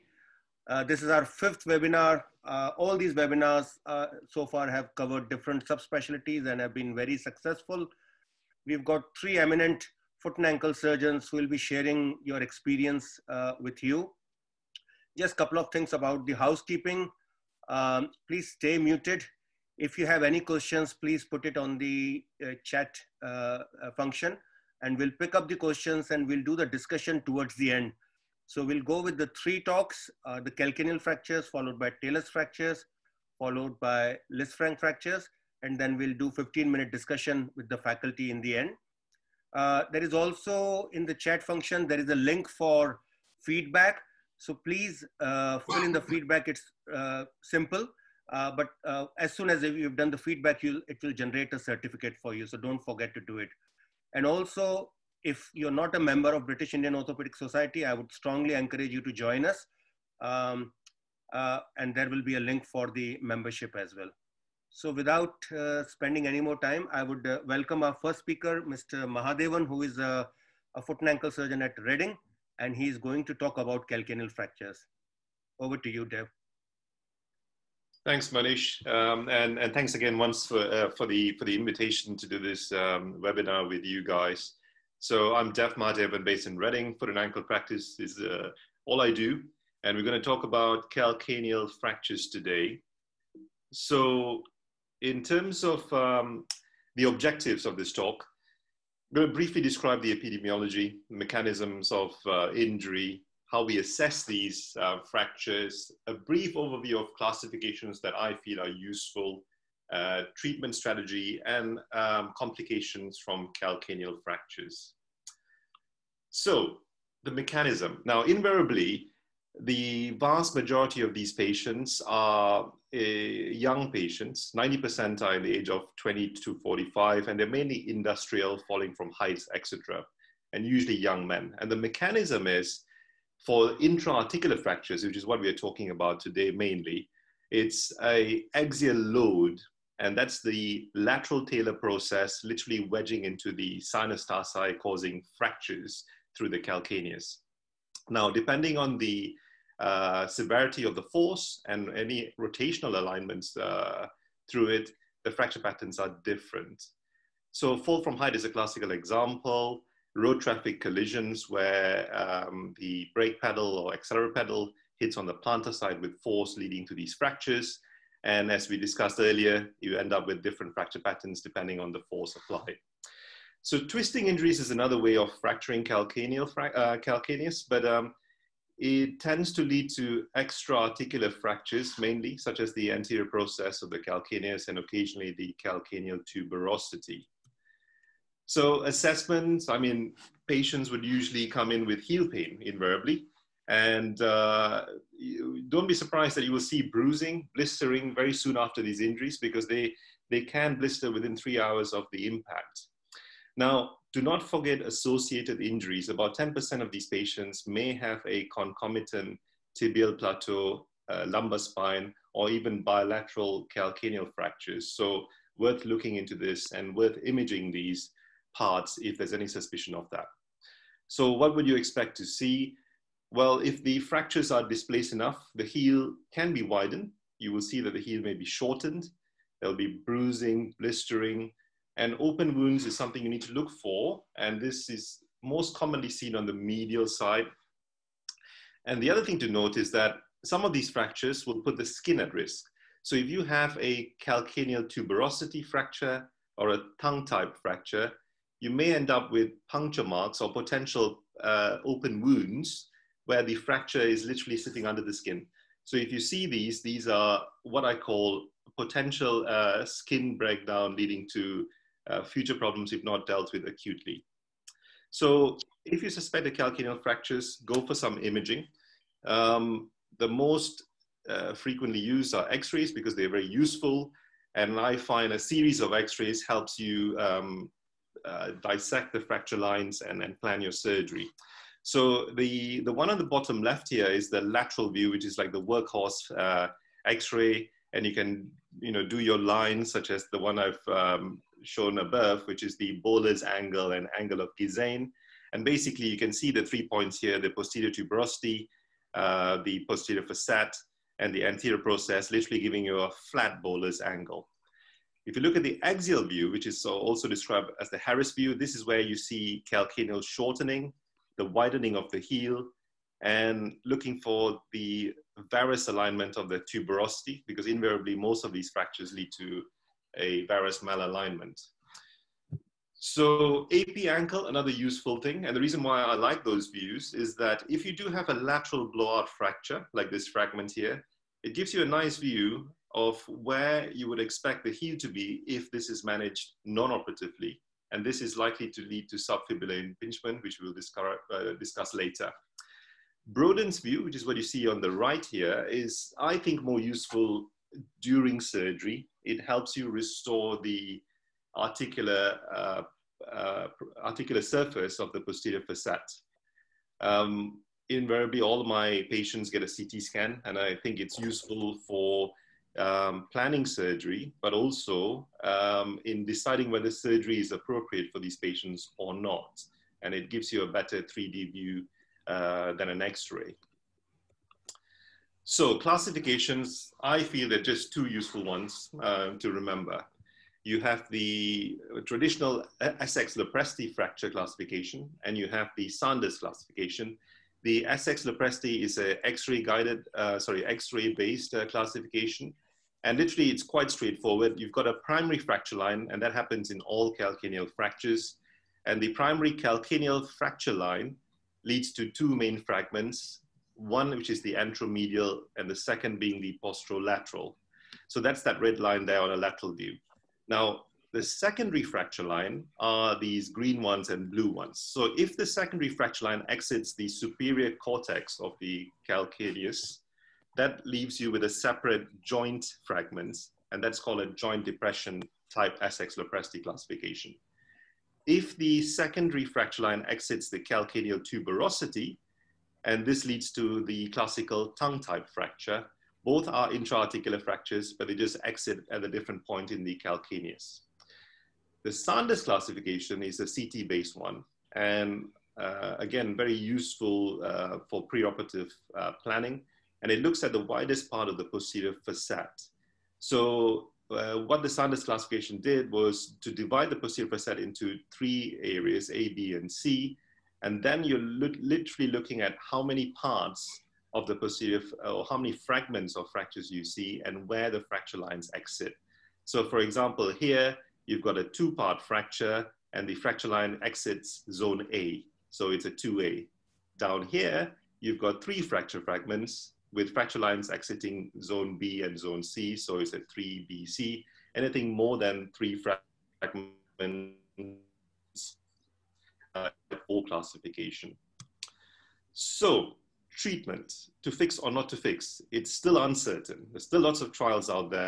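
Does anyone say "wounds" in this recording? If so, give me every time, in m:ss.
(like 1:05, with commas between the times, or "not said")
3:52, 4:12.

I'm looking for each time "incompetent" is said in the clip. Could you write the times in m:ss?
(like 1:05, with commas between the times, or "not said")
not said.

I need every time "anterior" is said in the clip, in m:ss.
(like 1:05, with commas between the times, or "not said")
3:02, 5:01.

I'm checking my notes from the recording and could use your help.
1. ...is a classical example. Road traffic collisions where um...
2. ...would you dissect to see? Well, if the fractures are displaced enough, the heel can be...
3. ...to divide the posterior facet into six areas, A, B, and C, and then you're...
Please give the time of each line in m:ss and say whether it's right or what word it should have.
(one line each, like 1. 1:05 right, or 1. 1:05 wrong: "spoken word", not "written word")
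1. 2:38 right
2. 3:41 wrong: "expect", not "dissect"
3. 7:36 wrong: "three", not "six".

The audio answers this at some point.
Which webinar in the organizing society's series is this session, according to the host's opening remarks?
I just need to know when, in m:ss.
0:01.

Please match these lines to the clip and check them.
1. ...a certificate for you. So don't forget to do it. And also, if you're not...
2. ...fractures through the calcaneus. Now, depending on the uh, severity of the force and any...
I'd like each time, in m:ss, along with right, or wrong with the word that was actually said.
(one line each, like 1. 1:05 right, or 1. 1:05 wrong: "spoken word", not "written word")
1. 0:51 right
2. 2:25 right.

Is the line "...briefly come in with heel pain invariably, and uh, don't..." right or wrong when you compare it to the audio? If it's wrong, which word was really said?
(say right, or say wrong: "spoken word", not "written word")
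wrong: "usually", not "briefly".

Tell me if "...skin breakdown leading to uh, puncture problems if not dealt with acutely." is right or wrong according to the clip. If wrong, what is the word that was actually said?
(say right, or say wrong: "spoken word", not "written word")
wrong: "future", not "puncture".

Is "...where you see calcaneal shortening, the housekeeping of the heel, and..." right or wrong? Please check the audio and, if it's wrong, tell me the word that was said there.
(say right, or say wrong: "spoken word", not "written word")
wrong: "widening", not "housekeeping".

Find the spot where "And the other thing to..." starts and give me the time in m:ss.
3:58.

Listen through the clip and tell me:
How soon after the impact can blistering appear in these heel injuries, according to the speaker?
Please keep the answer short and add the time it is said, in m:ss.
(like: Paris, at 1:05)
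3 hours, at 3:21.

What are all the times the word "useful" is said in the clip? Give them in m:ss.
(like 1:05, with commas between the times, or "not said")
1:48, 4:33, 5:24, 5:46, 6:01, 6:18, 7:26.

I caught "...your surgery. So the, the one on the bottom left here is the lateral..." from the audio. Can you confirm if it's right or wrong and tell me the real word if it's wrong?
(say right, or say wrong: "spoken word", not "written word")
right.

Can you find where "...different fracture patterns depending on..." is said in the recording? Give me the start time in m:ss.
2:50.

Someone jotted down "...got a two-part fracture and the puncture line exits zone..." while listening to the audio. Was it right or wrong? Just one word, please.
wrong.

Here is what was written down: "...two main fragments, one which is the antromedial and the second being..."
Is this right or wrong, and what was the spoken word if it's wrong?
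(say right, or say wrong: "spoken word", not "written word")
right.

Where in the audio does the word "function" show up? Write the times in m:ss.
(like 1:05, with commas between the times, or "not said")
0:23, 0:41.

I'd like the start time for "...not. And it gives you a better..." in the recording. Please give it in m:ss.
6:09.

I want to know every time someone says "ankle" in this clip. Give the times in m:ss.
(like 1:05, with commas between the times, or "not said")
0:10, 1:11, 1:27, 5:24.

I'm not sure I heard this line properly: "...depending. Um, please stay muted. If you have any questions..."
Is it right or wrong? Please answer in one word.
wrong.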